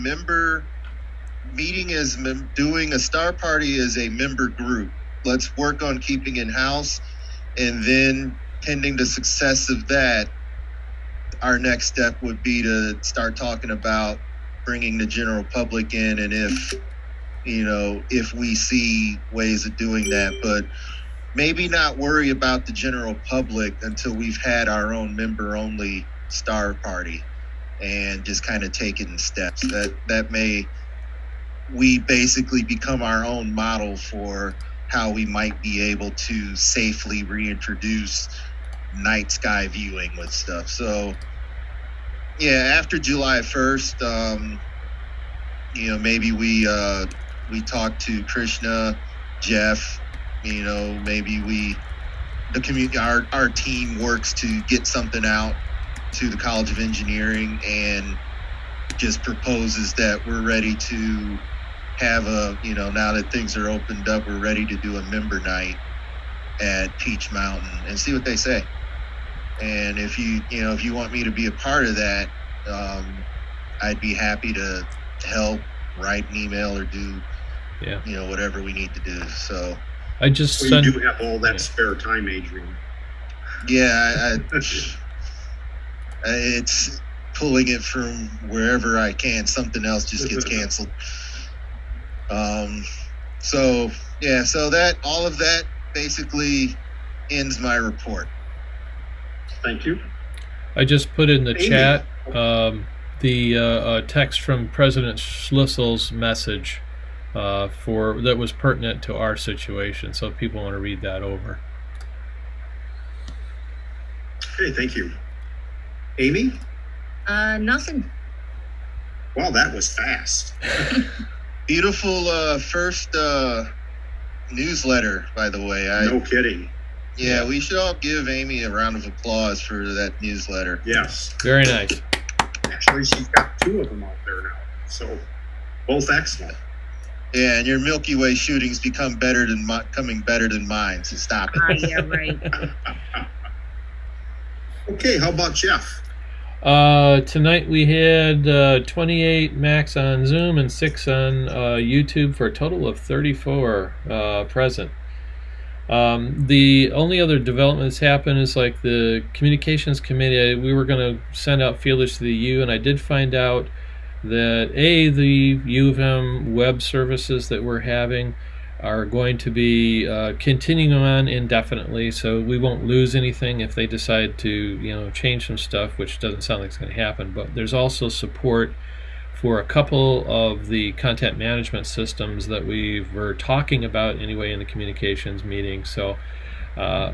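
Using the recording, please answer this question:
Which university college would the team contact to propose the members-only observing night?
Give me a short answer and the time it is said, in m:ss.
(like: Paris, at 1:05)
College of Engineering, at 0:56.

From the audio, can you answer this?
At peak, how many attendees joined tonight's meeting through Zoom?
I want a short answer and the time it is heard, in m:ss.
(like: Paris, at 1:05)
28, at 2:28.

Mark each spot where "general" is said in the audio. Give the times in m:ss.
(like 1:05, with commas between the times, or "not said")
0:15, 0:22.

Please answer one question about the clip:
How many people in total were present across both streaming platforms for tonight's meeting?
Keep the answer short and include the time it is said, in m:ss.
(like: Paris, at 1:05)
34, at 2:32.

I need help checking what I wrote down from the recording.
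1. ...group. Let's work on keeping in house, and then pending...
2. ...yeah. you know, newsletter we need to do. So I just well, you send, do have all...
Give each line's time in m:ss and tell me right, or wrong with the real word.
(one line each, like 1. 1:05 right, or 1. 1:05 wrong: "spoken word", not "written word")
1. 0:04 right
2. 1:17 wrong: "whatever", not "newsletter".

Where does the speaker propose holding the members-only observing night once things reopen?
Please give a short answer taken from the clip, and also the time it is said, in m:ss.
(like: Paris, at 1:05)
Peach Mountain, at 1:06.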